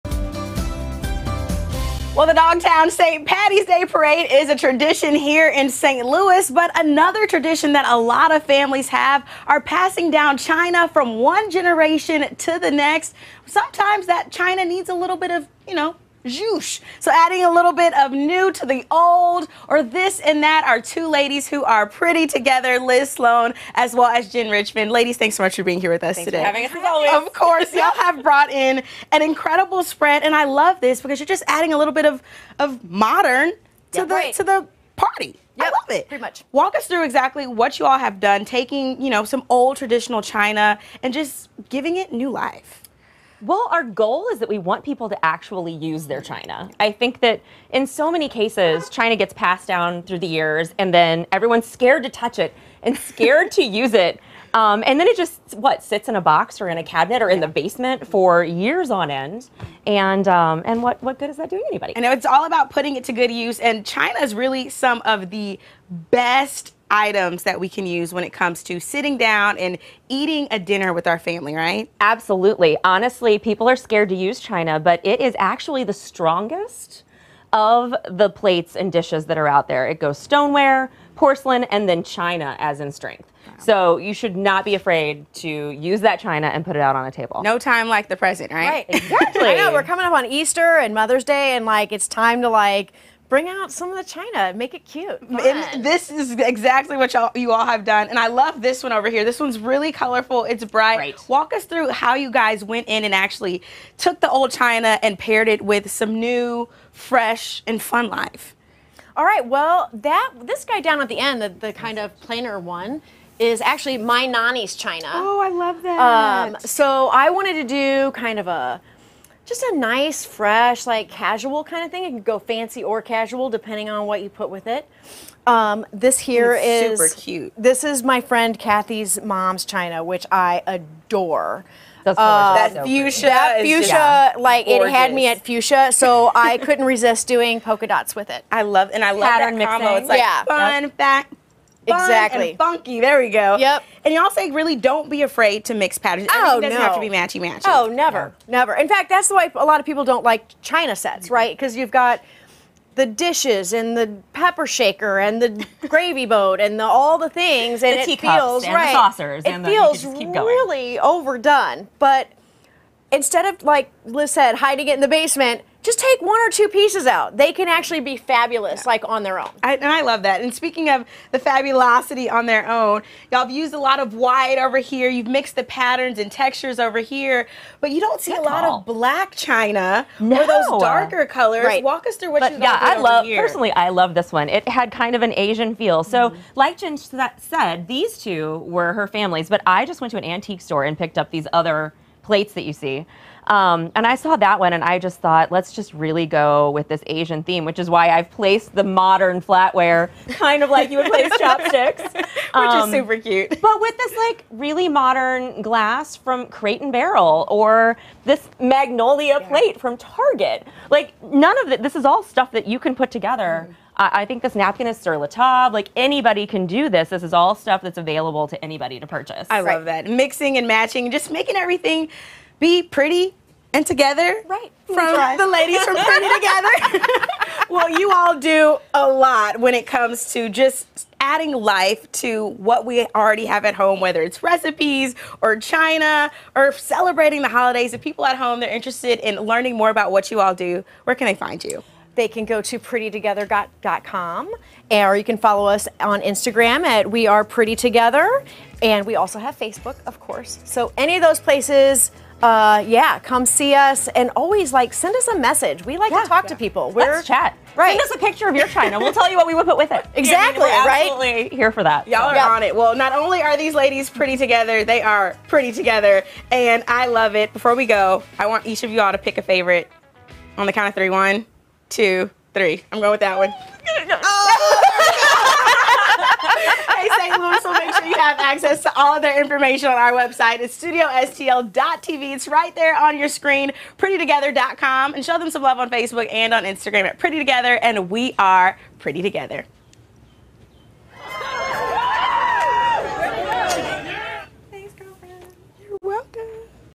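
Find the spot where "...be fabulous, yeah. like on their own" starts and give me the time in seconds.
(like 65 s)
168 s.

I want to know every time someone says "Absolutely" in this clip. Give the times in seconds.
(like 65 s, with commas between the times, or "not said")
72 s, 261 s.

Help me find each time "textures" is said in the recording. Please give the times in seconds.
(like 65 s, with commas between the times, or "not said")
176 s.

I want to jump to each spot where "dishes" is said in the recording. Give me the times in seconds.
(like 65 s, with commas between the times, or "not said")
78 s, 153 s.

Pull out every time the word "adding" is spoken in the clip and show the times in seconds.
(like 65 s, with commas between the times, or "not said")
17 s, 31 s, 231 s.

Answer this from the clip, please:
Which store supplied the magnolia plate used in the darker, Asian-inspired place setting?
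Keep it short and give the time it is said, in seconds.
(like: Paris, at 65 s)
Target, at 209 s.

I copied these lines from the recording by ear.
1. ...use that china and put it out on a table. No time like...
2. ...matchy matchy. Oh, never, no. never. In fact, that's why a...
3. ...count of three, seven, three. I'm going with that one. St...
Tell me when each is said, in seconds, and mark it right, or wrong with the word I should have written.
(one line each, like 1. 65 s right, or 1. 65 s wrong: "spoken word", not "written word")
1. 85 s right
2. 147 s right
3. 270 s wrong: "two", not "seven".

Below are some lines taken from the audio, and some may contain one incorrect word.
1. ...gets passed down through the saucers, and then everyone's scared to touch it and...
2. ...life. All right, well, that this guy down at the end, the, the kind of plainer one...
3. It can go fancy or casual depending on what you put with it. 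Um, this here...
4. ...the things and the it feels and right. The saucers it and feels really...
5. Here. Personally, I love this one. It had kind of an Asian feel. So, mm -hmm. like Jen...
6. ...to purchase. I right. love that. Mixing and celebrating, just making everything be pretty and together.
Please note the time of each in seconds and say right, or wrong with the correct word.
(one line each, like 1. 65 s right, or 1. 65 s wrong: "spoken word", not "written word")
1. 49 s wrong: "years", not "saucers"
2. 108 s right
3. 122 s right
4. 157 s right
5. 183 s right
6. 218 s wrong: "matching", not "celebrating".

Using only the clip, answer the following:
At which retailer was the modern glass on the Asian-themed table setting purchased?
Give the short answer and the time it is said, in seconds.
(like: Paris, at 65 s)
Crate and Barrel, at 206 s.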